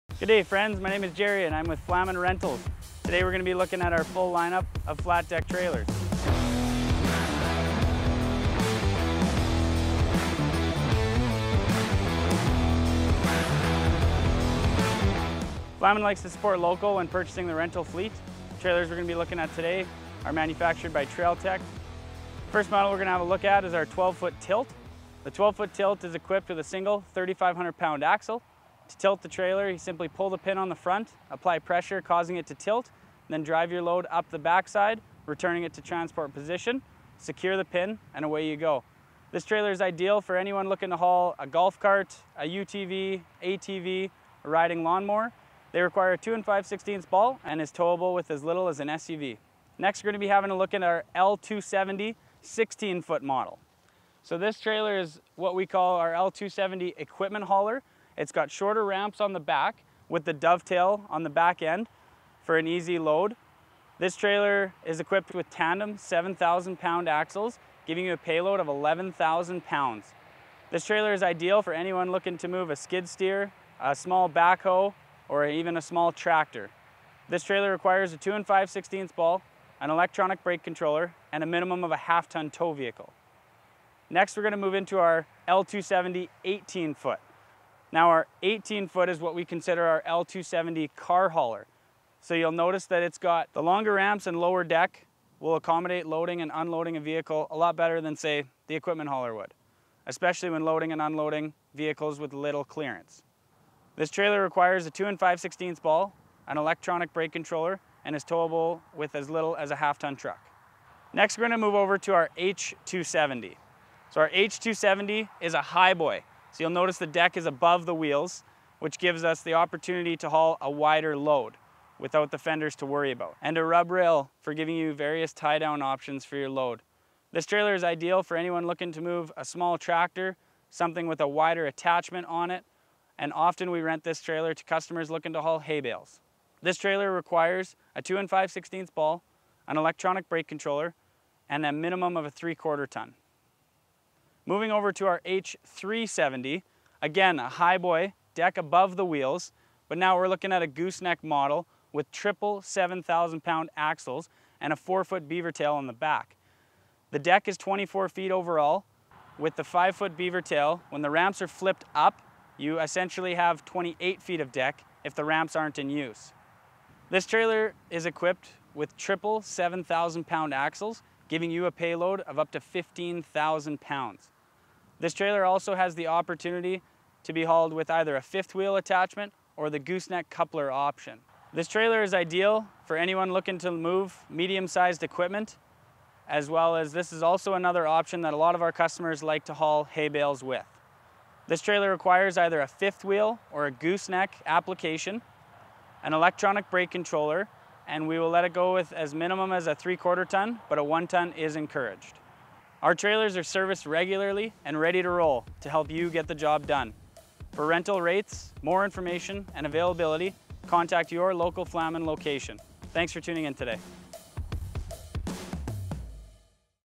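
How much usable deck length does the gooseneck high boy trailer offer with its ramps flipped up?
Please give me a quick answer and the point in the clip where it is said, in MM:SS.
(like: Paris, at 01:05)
28 feet, at 02:43.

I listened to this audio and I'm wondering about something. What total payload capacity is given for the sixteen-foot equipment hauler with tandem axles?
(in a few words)
11,000 pounds.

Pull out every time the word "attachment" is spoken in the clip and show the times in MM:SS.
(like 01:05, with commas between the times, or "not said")
02:11, 02:58.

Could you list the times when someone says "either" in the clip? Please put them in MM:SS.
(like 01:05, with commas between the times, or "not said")
02:57, 03:12.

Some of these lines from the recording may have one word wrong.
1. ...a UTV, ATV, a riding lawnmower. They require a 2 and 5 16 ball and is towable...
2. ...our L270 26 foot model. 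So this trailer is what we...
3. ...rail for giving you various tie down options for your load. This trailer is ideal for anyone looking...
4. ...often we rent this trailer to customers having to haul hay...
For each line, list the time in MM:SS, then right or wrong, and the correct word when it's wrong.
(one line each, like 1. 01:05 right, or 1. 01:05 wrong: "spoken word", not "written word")
1. 00:42 right
2. 00:50 wrong: "16", not "26"
3. 02:03 right
4. 02:13 wrong: "looking", not "having".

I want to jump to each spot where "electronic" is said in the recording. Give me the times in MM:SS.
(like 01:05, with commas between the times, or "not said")
01:19, 01:46, 02:19, 03:16.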